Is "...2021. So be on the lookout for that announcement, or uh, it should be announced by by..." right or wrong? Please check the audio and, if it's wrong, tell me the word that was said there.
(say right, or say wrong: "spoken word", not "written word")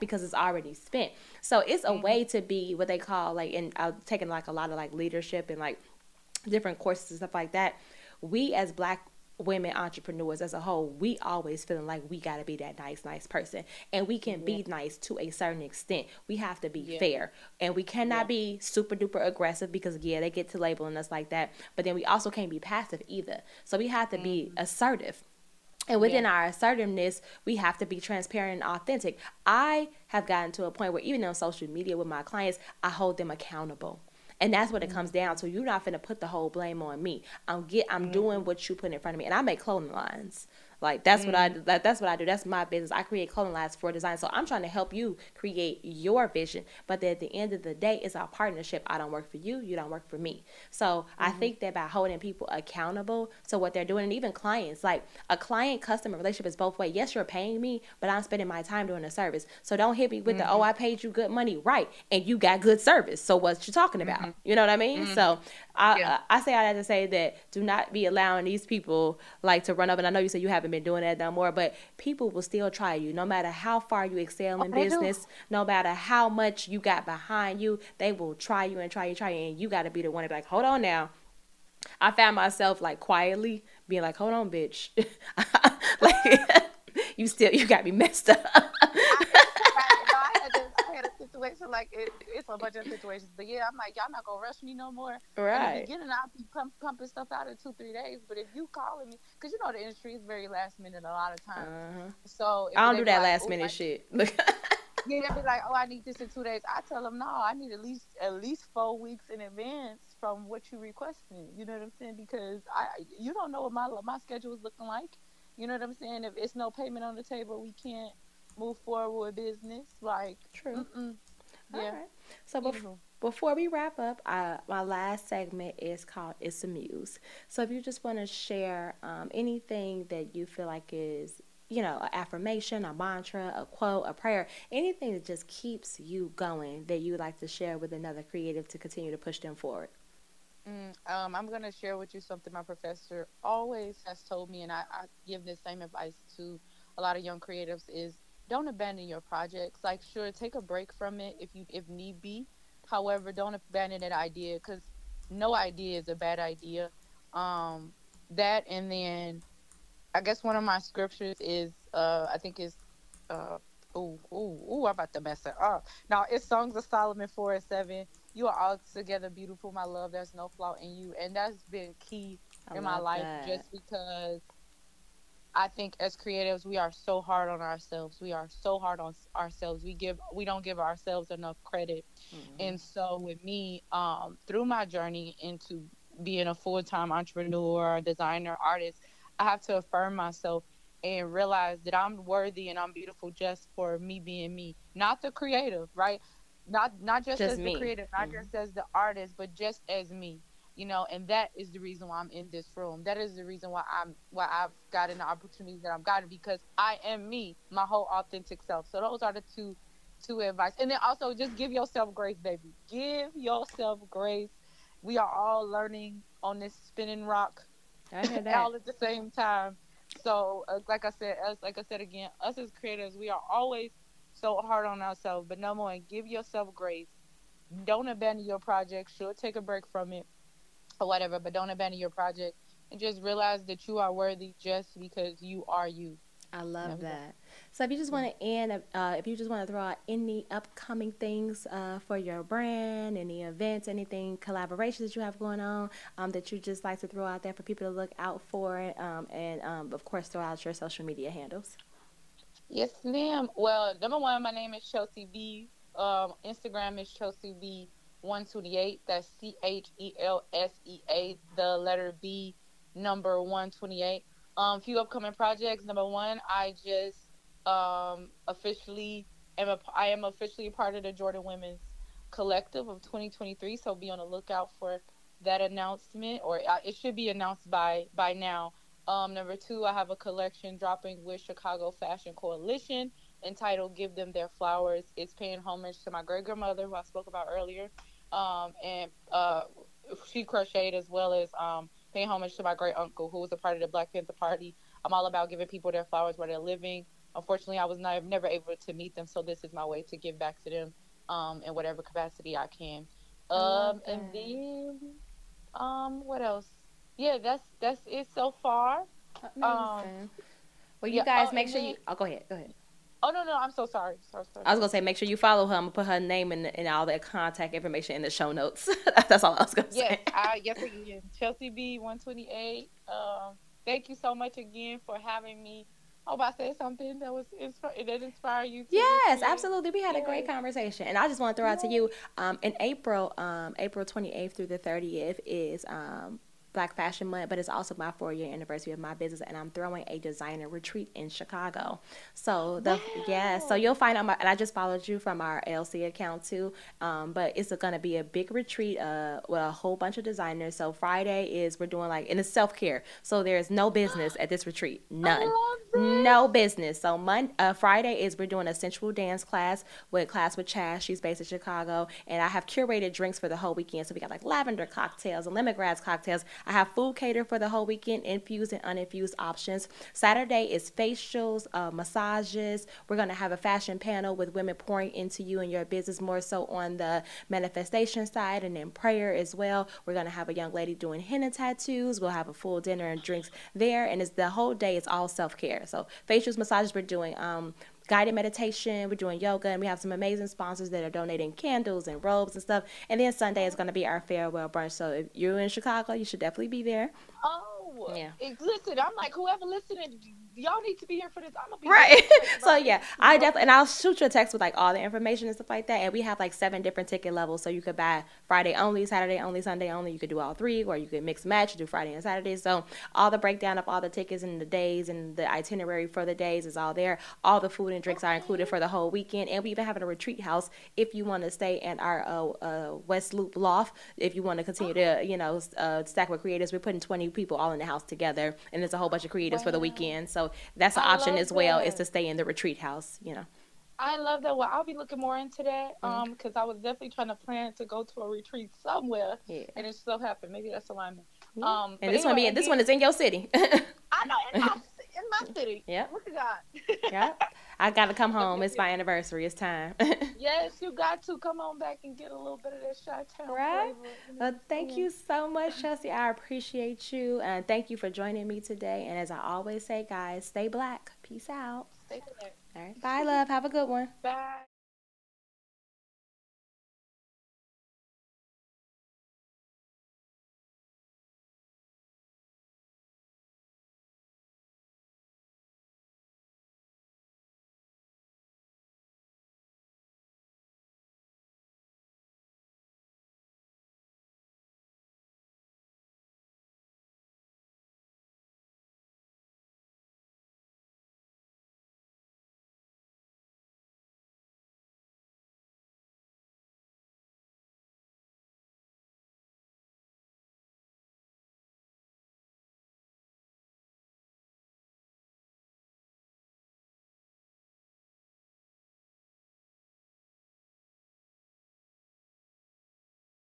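wrong: "2023", not "2021".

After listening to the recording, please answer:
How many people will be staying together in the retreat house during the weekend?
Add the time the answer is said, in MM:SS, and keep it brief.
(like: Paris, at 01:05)
20, at 07:06.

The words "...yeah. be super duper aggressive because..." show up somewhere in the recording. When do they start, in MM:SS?
00:18.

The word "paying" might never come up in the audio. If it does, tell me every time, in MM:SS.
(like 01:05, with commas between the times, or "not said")
00:57, 04:45, 04:52.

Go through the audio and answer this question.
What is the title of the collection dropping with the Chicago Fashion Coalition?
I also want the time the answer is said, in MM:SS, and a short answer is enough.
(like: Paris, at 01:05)
Give Them Their Flowers, at 04:43.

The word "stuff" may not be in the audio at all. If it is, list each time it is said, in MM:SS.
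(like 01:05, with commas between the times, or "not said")
00:07, 01:37, 06:32, 06:45.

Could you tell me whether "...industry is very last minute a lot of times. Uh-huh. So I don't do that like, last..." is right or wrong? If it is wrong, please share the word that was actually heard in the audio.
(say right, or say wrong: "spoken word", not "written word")
right.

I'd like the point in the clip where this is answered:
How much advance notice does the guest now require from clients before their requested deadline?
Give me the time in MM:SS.
01:48.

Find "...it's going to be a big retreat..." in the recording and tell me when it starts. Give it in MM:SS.
05:47.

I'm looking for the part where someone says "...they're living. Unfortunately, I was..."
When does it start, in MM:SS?
04:56.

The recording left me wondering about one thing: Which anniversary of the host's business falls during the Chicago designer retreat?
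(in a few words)
4 year.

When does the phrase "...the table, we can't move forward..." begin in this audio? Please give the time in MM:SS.
01:57.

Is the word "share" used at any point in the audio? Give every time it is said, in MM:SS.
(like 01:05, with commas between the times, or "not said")
02:08, 02:17, 02:21.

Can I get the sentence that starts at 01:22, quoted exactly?
I found myself like quietly being like, hold on, bitch.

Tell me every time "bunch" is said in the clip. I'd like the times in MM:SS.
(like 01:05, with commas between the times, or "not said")
01:32, 05:49, 07:09.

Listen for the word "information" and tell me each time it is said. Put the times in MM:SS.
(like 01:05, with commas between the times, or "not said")
05:17, 06:44.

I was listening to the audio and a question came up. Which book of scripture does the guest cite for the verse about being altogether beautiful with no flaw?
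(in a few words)
Songs of Solomon.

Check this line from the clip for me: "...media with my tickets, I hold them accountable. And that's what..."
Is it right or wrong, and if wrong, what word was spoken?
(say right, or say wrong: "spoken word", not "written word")
wrong: "clients", not "tickets".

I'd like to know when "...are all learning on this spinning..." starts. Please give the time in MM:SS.
03:35.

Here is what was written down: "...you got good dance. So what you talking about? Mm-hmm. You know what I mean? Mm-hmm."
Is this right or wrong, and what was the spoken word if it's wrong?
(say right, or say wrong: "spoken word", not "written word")
wrong: "service", not "dance".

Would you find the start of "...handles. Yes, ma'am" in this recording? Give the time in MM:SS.
04:11.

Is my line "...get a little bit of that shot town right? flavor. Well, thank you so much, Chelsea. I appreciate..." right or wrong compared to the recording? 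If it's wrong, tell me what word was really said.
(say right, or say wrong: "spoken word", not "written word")
right.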